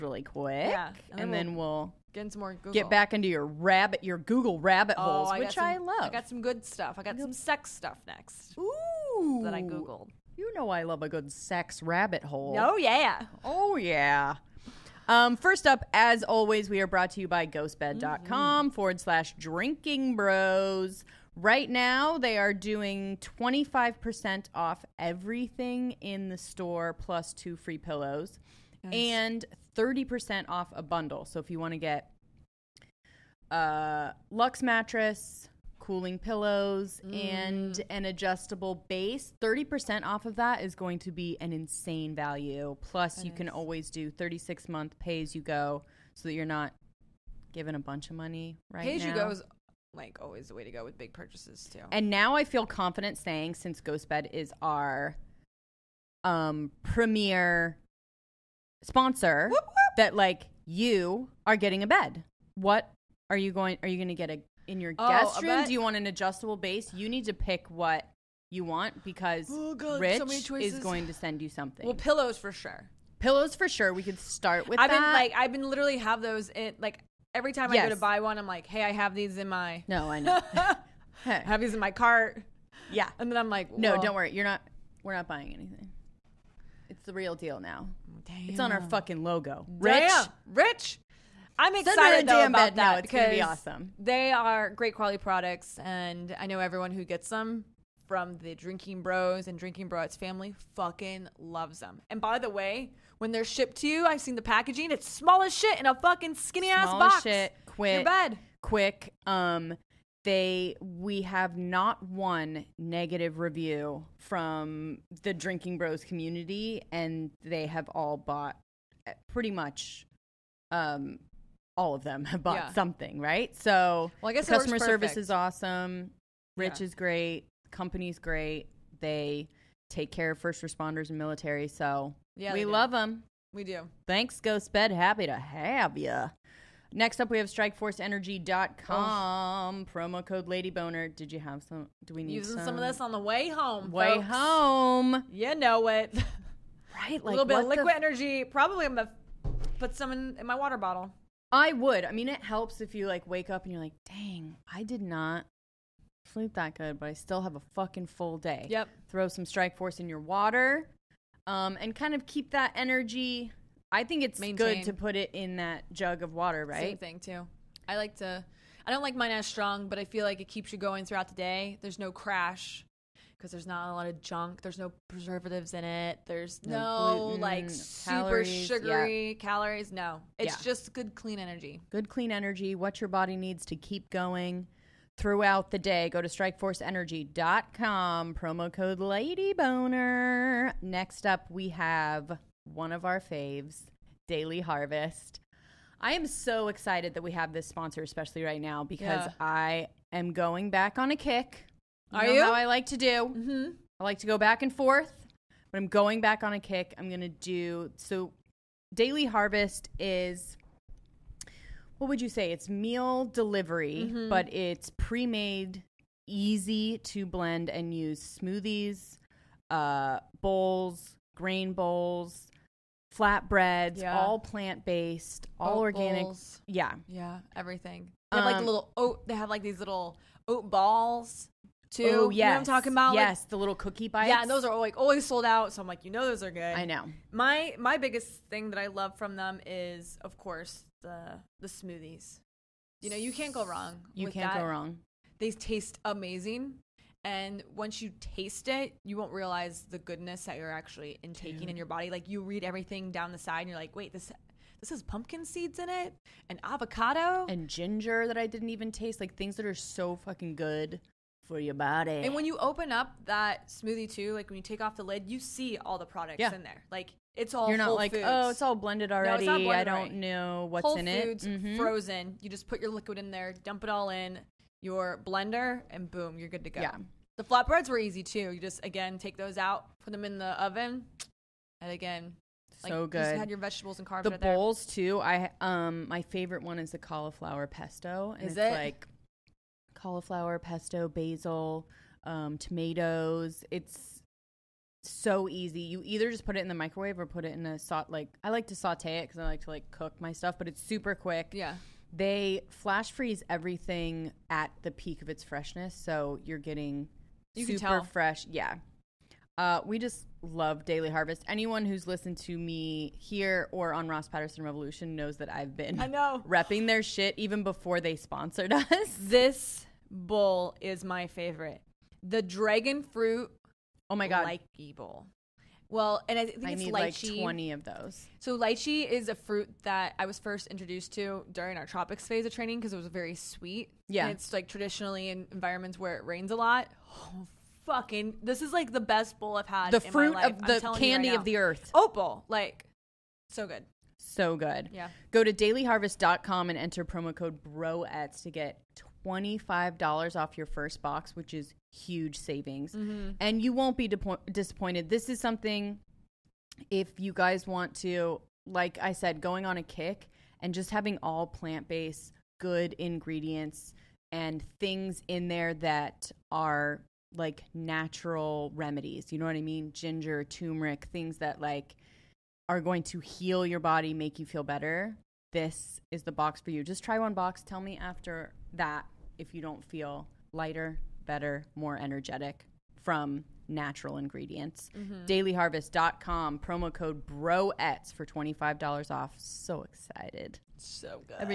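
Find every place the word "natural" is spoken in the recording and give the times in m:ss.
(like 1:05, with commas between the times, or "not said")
6:07, 6:23.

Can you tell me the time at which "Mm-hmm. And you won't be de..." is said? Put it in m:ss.
5:52.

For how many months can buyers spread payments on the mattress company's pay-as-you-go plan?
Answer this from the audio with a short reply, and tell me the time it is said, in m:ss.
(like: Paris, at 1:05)
36, at 0:44.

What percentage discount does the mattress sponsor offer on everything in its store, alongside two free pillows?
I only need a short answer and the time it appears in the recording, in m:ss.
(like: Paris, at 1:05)
25%, at 0:23.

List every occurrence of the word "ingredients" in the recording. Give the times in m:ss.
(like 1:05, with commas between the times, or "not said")
6:02, 6:24.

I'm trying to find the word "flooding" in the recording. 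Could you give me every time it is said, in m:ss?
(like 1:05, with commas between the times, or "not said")
not said.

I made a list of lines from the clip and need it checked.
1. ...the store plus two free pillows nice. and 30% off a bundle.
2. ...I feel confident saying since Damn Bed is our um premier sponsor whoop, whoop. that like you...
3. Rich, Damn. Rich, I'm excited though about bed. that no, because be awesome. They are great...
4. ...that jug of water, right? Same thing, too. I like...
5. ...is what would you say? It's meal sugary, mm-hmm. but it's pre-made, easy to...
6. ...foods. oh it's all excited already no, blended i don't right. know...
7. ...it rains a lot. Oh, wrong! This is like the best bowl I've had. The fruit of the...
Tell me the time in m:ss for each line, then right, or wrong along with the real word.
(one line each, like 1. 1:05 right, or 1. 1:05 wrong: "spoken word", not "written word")
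1. 0:26 right
2. 0:52 wrong: "Ghost", not "Damn"
3. 1:29 right
4. 2:45 right
5. 3:29 wrong: "delivery", not "sugary"
6. 4:28 wrong: "blended", not "excited"
7. 5:36 wrong: "fucking", not "wrong".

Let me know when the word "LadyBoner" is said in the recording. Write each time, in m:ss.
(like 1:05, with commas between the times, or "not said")
2:20, 3:08.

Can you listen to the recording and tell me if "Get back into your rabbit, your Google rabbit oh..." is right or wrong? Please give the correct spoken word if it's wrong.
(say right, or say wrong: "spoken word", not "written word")
right.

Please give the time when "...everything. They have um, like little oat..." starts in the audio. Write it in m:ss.
3:47.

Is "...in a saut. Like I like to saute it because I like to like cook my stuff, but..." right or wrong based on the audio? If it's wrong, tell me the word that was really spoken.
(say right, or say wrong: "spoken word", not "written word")
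right.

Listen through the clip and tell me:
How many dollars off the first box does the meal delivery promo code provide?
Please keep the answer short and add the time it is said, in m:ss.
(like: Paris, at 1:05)
$25, at 5:49.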